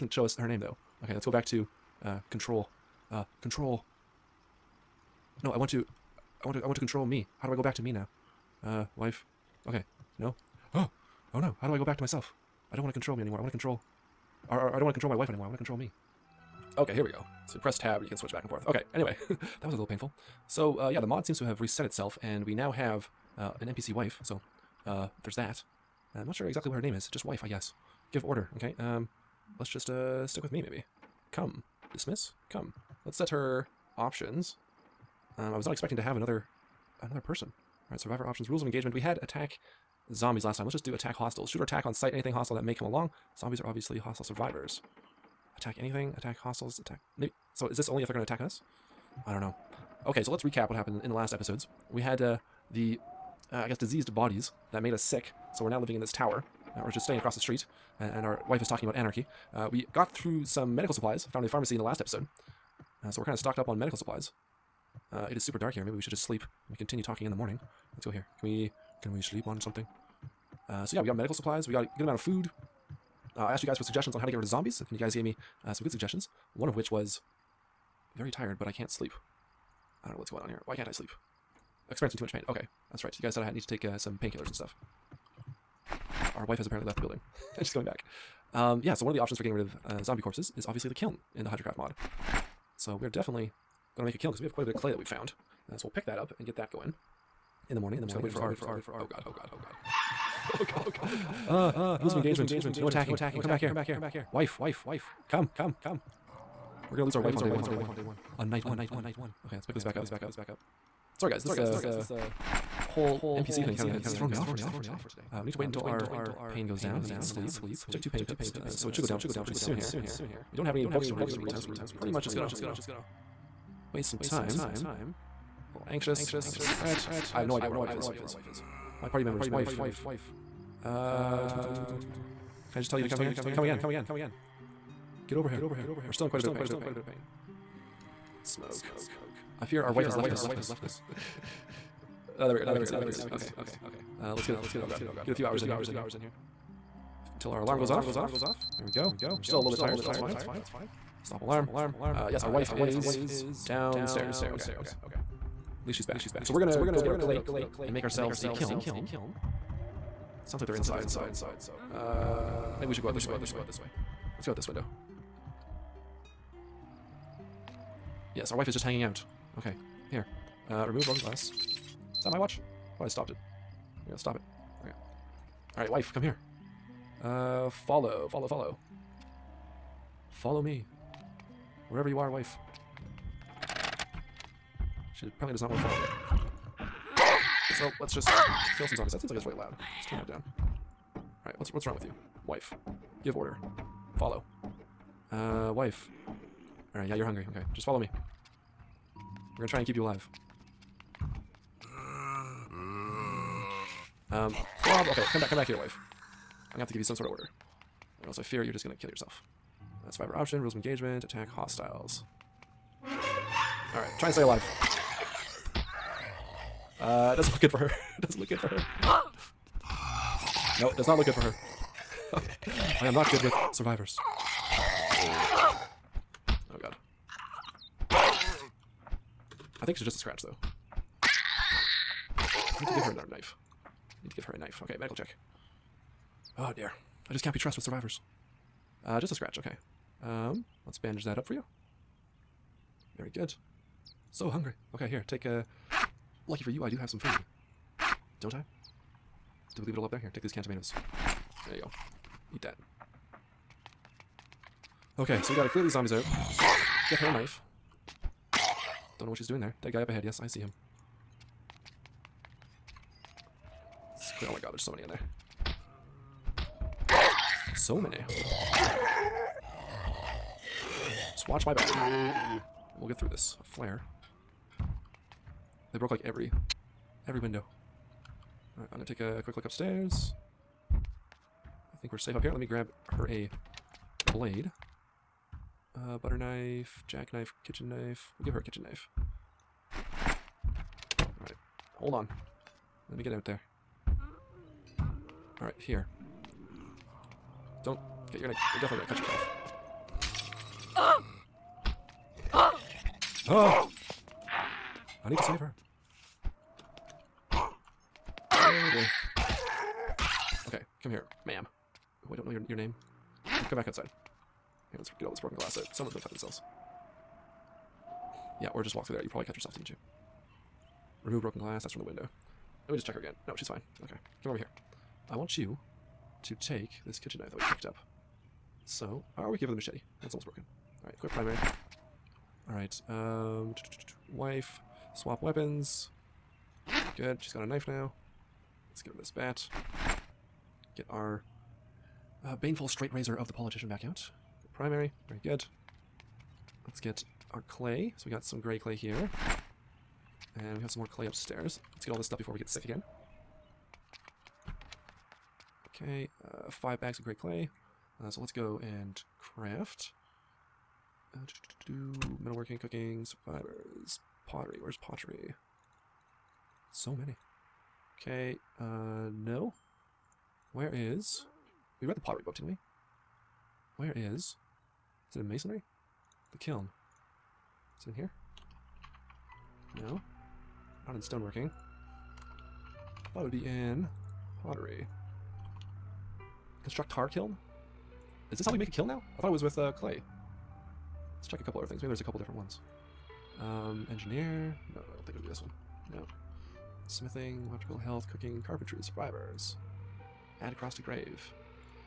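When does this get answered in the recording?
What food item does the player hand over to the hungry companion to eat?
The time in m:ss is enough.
4:10.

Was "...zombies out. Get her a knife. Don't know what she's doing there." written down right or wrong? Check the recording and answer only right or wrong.
right.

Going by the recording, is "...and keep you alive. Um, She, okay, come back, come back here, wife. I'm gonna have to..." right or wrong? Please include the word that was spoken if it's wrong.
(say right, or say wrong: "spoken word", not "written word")
wrong: "Bob", not "She".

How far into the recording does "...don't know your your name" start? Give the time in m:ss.
5:12.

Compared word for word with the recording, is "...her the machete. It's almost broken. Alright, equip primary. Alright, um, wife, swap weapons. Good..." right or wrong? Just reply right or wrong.
right.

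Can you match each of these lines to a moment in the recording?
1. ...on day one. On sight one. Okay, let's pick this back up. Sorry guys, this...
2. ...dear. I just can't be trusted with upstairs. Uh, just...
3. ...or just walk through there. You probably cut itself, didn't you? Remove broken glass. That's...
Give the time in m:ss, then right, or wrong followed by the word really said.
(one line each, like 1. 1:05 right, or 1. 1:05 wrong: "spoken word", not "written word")
1. 1:47 wrong: "night", not "sight"
2. 3:56 wrong: "survivors", not "upstairs"
3. 5:18 wrong: "yourself", not "itself".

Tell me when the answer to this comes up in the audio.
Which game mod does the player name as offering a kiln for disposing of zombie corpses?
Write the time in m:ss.
1:31.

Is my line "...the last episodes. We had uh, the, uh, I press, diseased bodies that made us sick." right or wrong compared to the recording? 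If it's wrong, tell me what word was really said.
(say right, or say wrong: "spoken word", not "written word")
wrong: "guess", not "press".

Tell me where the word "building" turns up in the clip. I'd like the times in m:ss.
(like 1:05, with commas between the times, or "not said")
1:27.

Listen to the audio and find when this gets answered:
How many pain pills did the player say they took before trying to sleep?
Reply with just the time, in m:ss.
1:58.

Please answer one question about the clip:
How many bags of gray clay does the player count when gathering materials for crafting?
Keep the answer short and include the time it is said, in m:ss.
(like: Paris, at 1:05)
5, at 5:56.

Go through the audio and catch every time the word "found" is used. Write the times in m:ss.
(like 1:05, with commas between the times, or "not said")
1:01, 1:35.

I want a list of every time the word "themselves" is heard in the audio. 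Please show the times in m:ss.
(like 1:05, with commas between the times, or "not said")
5:16.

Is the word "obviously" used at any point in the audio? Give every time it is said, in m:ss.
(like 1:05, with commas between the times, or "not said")
0:43, 1:30.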